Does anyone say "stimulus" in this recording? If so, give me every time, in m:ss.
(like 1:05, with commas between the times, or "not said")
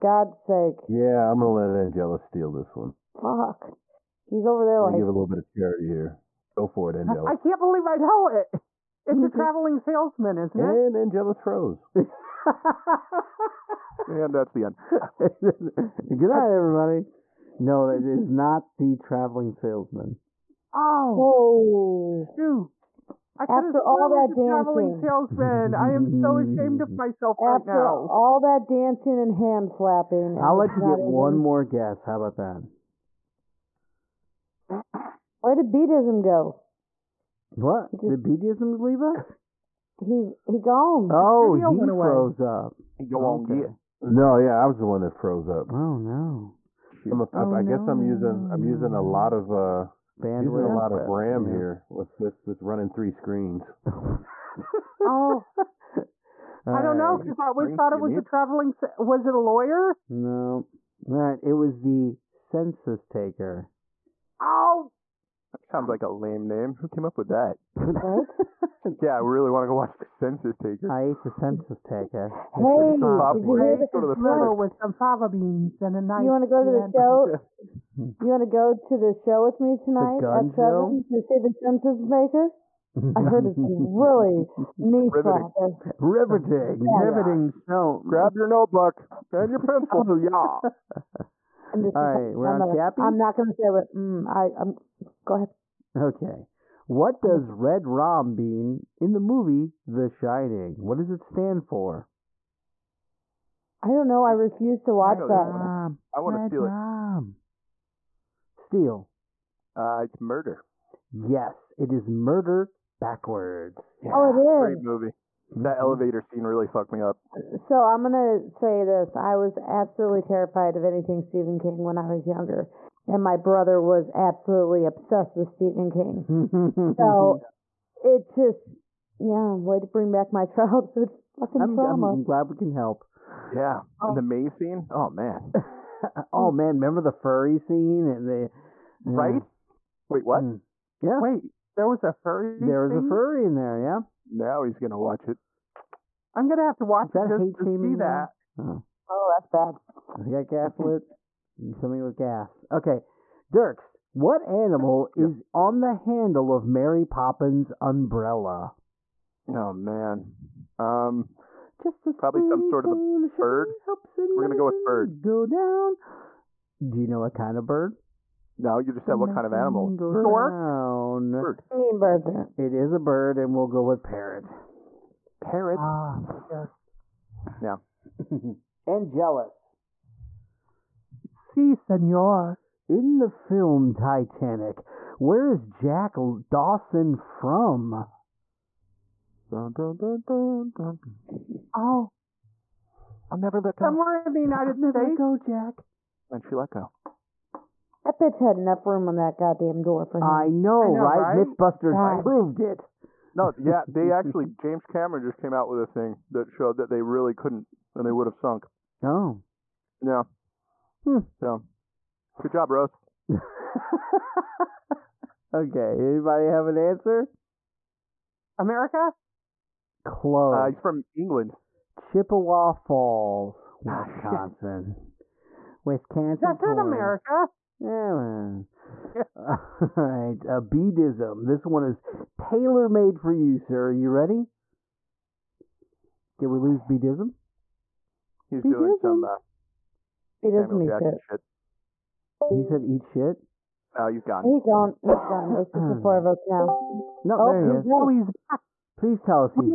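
not said.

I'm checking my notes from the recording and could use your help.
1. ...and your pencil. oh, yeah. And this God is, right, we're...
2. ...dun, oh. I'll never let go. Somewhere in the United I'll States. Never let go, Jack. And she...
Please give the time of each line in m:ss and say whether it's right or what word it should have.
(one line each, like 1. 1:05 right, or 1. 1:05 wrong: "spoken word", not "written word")
1. 1:29 wrong: "All", not "God"
2. 3:10 right.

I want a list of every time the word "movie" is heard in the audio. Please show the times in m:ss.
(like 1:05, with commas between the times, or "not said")
1:39, 1:54.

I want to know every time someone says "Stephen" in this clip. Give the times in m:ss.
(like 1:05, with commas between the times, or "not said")
2:01, 2:05.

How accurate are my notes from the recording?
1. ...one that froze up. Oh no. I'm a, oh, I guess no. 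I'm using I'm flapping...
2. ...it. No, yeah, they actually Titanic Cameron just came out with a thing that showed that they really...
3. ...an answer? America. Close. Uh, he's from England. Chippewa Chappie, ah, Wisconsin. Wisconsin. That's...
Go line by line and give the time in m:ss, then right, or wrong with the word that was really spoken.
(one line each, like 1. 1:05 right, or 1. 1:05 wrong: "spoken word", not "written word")
1. 0:44 wrong: "using", not "flapping"
2. 3:22 wrong: "James", not "Titanic"
3. 3:36 wrong: "Falls", not "Chappie".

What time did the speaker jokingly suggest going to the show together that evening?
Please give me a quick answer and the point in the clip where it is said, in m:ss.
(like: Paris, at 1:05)
7, at 1:20.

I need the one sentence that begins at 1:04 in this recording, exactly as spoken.
Oh, that sounds like a lame name.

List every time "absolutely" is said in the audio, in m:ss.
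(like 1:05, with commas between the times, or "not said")
1:59, 2:04.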